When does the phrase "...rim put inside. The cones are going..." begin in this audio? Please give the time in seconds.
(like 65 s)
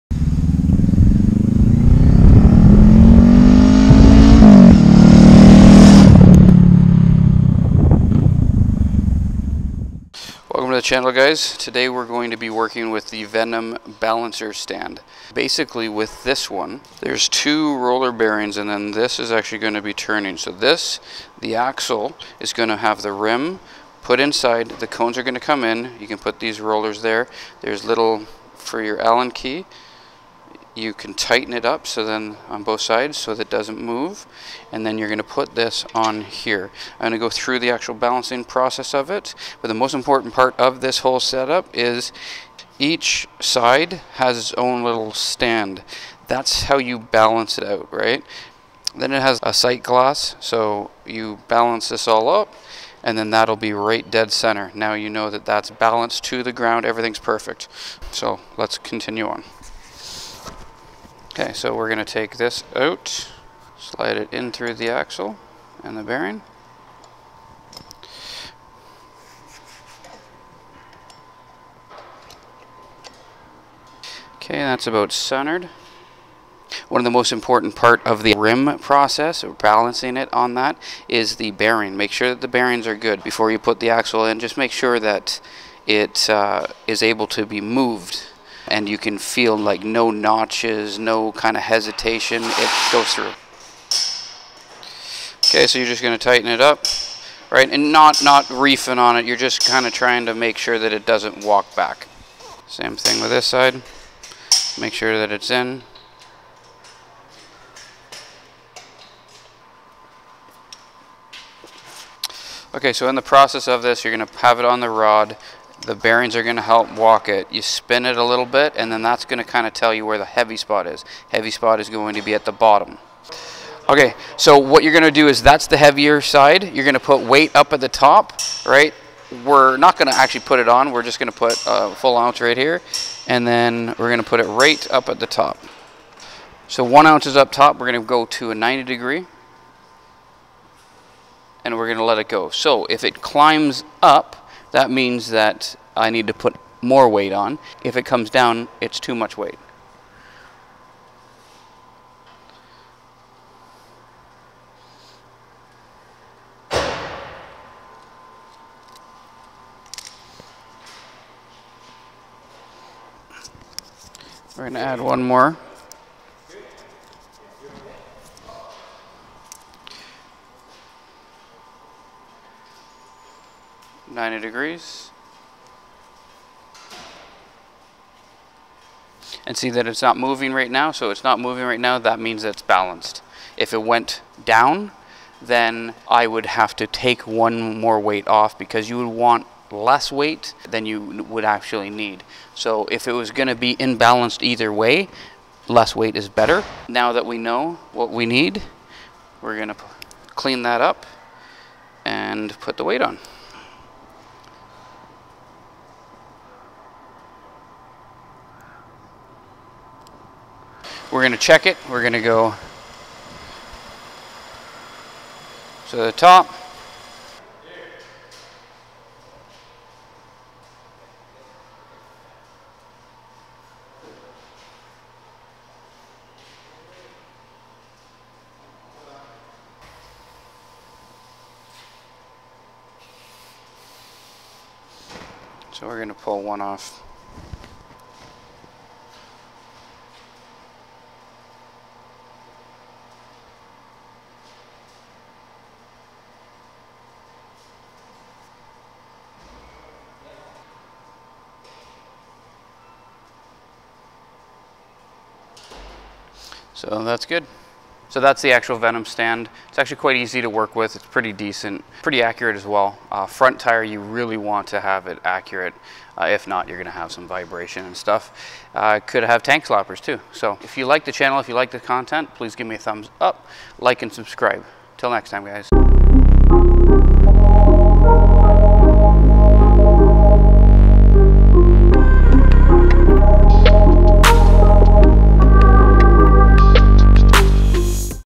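23 s.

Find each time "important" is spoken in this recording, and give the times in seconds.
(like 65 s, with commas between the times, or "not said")
39 s, 77 s.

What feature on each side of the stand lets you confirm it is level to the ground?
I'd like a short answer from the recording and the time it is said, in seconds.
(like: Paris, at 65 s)
sight glass, at 49 s.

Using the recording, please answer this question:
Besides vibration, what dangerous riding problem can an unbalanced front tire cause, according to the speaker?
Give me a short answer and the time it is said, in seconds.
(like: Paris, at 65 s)
tank slappers, at 269 s.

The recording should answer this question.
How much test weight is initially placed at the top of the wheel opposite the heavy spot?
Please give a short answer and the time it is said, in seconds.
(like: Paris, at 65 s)
1 ounce, at 131 s.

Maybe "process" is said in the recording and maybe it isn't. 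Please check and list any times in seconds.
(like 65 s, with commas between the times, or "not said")
38 s, 78 s, 113 s.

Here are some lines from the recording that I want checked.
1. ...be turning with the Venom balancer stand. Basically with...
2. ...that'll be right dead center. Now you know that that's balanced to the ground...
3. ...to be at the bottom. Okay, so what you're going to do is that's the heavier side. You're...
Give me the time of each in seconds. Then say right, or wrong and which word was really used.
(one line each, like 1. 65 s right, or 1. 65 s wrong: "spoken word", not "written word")
1. 12 s wrong: "working", not "turning"
2. 53 s right
3. 122 s right.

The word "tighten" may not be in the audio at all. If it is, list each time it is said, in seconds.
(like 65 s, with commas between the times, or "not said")
31 s, 96 s.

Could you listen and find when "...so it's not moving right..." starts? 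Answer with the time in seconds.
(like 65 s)
180 s.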